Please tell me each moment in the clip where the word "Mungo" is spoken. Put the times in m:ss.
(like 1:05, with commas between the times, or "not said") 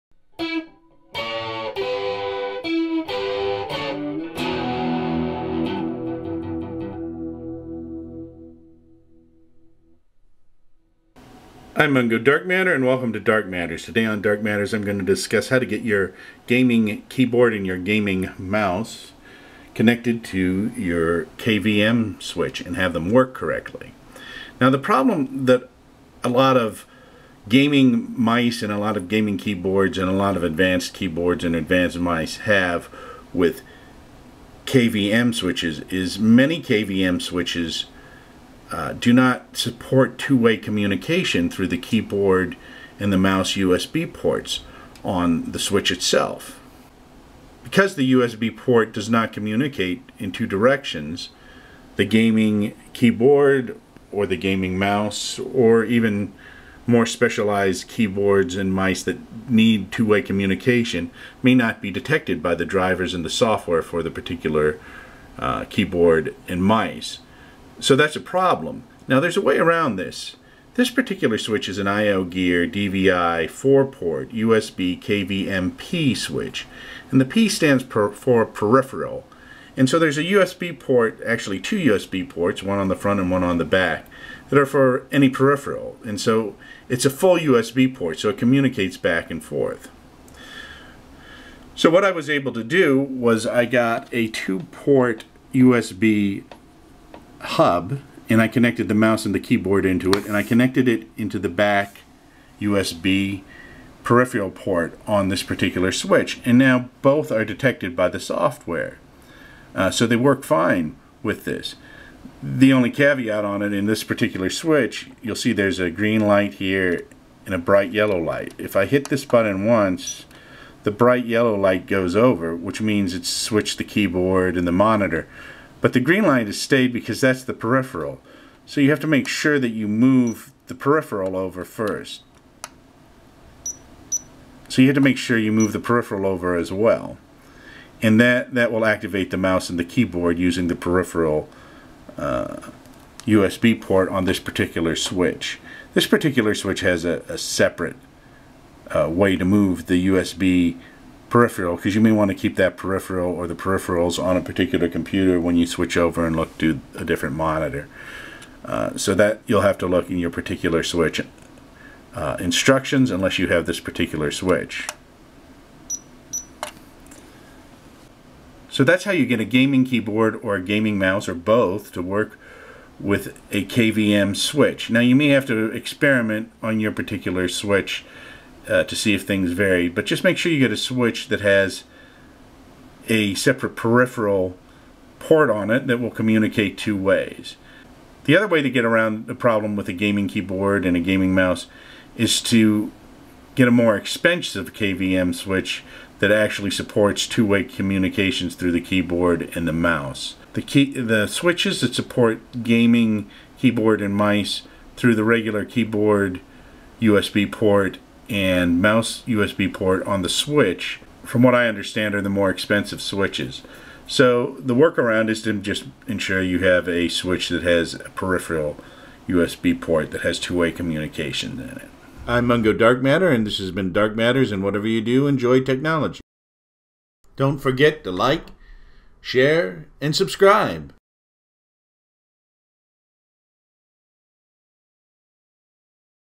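0:11, 3:42.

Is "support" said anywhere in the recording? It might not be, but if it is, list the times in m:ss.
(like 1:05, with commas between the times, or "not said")
0:39, 3:16, 3:21.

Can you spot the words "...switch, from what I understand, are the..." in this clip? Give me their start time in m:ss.
3:30.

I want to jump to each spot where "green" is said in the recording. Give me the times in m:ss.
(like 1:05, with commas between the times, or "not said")
1:55, 2:05.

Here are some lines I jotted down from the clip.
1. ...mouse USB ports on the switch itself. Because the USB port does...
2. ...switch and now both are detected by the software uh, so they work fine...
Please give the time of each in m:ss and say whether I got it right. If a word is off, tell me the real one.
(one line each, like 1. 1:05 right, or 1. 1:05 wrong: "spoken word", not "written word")
1. 0:43 right
2. 1:45 right.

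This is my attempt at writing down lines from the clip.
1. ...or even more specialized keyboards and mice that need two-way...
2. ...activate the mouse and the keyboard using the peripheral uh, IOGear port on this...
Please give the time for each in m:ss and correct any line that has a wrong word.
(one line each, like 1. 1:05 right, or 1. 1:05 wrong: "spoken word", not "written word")
1. 0:55 right
2. 2:18 wrong: "USB", not "IOGear".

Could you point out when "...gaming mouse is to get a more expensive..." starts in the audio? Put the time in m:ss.
3:10.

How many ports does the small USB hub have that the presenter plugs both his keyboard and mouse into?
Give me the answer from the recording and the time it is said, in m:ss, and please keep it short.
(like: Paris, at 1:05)
2, at 1:34.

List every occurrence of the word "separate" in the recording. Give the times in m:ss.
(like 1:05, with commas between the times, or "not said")
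2:27, 3:03.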